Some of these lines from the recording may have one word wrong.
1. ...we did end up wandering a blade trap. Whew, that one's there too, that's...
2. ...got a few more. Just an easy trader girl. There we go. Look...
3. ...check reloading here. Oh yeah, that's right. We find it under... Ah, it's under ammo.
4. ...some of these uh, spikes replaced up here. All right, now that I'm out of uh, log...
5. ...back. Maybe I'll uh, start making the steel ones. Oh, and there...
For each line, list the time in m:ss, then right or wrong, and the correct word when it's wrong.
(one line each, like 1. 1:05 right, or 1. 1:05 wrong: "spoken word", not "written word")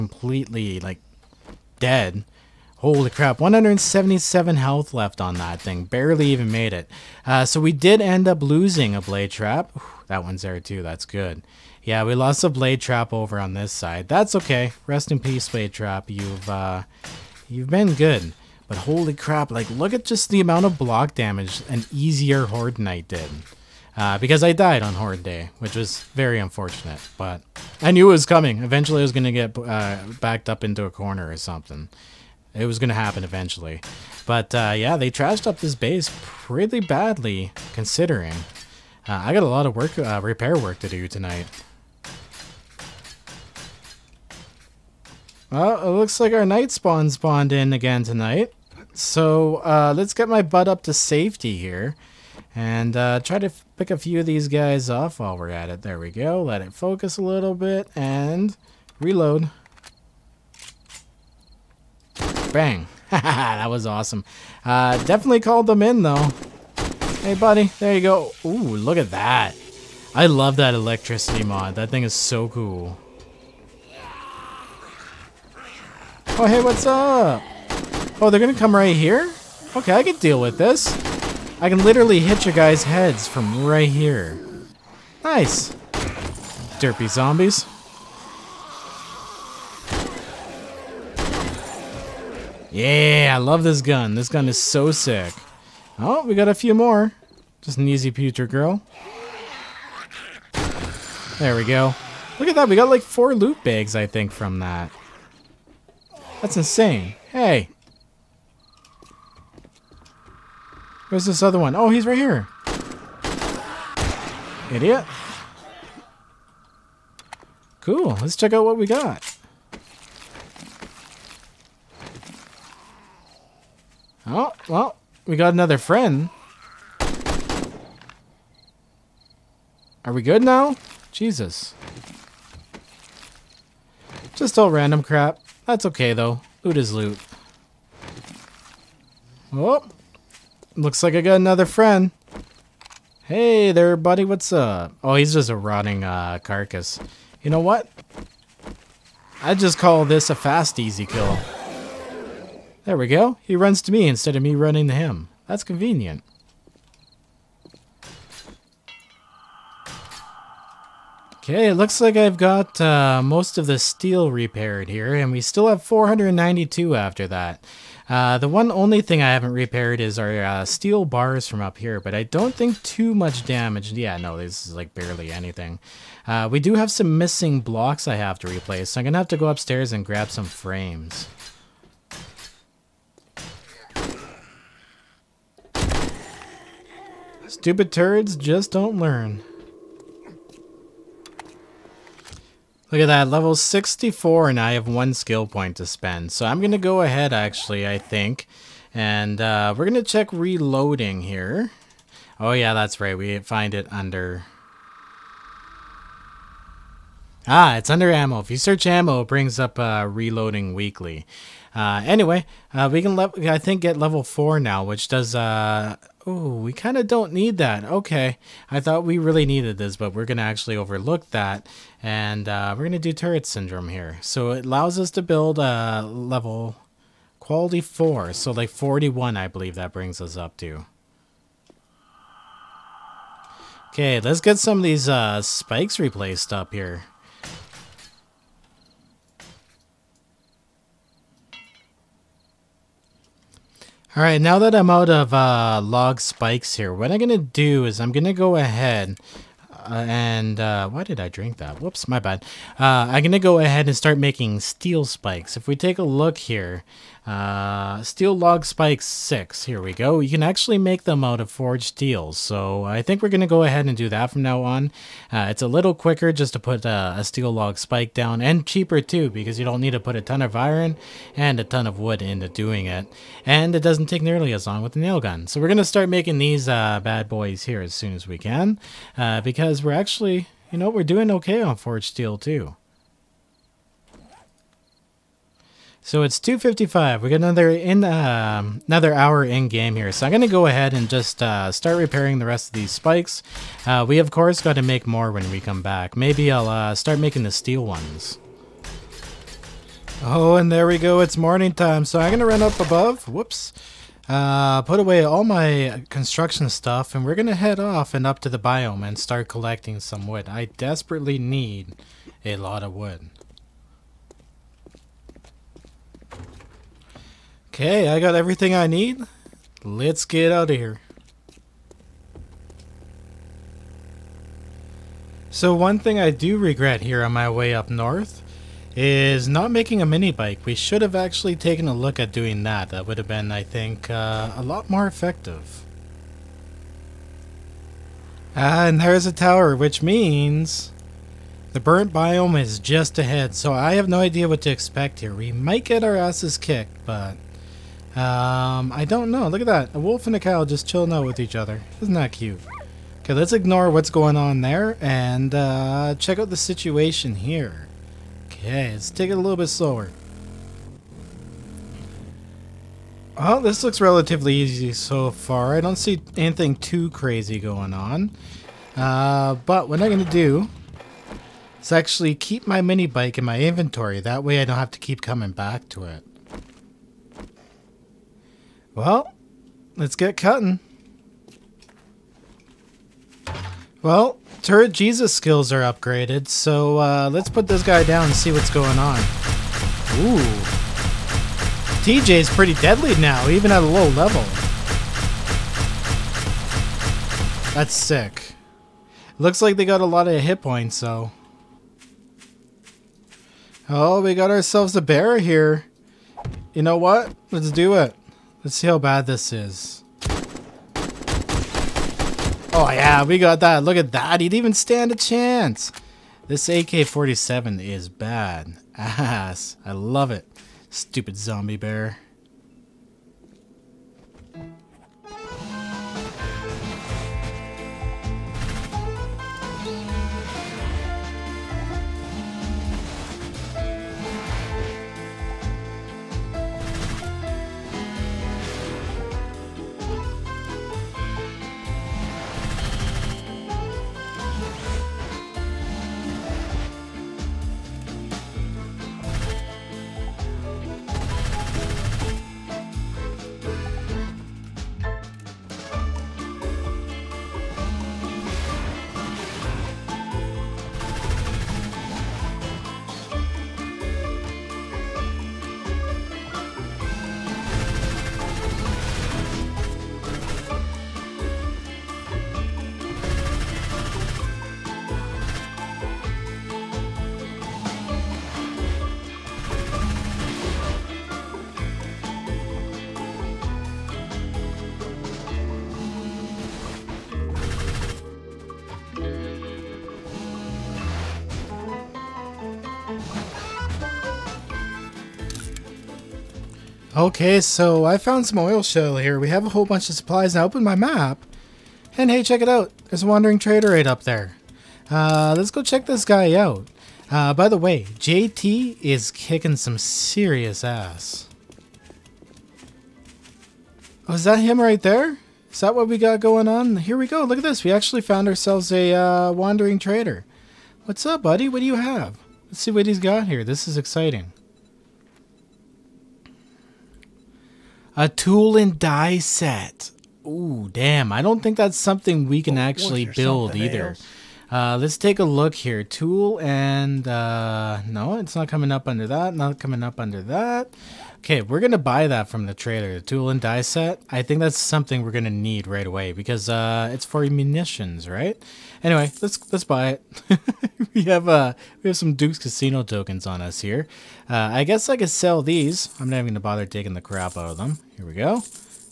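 1. 0:07 wrong: "losing", not "wandering"
2. 1:36 wrong: "pewter", not "trader"
3. 3:20 right
4. 3:54 right
5. 4:55 right.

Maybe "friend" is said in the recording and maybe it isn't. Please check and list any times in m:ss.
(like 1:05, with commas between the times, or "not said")
2:05, 2:21.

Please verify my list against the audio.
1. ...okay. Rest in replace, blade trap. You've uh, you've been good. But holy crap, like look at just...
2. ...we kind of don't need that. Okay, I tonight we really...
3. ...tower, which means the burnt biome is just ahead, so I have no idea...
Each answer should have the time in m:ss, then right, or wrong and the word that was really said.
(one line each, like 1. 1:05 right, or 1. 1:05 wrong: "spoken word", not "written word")
1. 0:14 wrong: "peace", not "replace"
2. 3:36 wrong: "thought", not "tonight"
3. 5:39 right.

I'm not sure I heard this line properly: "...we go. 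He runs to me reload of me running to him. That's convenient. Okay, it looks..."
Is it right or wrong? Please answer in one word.
wrong.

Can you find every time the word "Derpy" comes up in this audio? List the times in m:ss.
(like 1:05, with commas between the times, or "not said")
1:26.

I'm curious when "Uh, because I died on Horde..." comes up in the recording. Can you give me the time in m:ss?
0:23.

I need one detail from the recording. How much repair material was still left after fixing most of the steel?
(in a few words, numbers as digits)
492.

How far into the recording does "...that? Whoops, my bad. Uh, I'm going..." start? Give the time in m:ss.
4:11.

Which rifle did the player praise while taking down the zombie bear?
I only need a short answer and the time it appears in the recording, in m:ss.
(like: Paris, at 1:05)
AK-47, at 6:56.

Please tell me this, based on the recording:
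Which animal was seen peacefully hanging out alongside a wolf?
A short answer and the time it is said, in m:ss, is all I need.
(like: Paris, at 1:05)
Cow, at 5:50.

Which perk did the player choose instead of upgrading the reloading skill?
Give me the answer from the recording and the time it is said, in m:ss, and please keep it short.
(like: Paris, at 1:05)
Turret Syndrome, at 3:43.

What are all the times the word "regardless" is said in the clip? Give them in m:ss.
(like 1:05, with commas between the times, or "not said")
not said.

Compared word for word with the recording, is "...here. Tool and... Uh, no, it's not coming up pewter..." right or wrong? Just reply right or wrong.
wrong.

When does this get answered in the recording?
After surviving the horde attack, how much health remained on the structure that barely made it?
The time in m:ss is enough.
0:03.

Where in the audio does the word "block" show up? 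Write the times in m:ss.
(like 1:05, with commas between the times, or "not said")
0:20, 2:57.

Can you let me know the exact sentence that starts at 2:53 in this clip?
Yeah, no, this is like barely anything.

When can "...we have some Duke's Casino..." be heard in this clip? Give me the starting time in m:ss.
9:12.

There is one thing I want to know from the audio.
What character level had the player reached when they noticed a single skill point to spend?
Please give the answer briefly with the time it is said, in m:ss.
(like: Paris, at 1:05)
64, at 3:13.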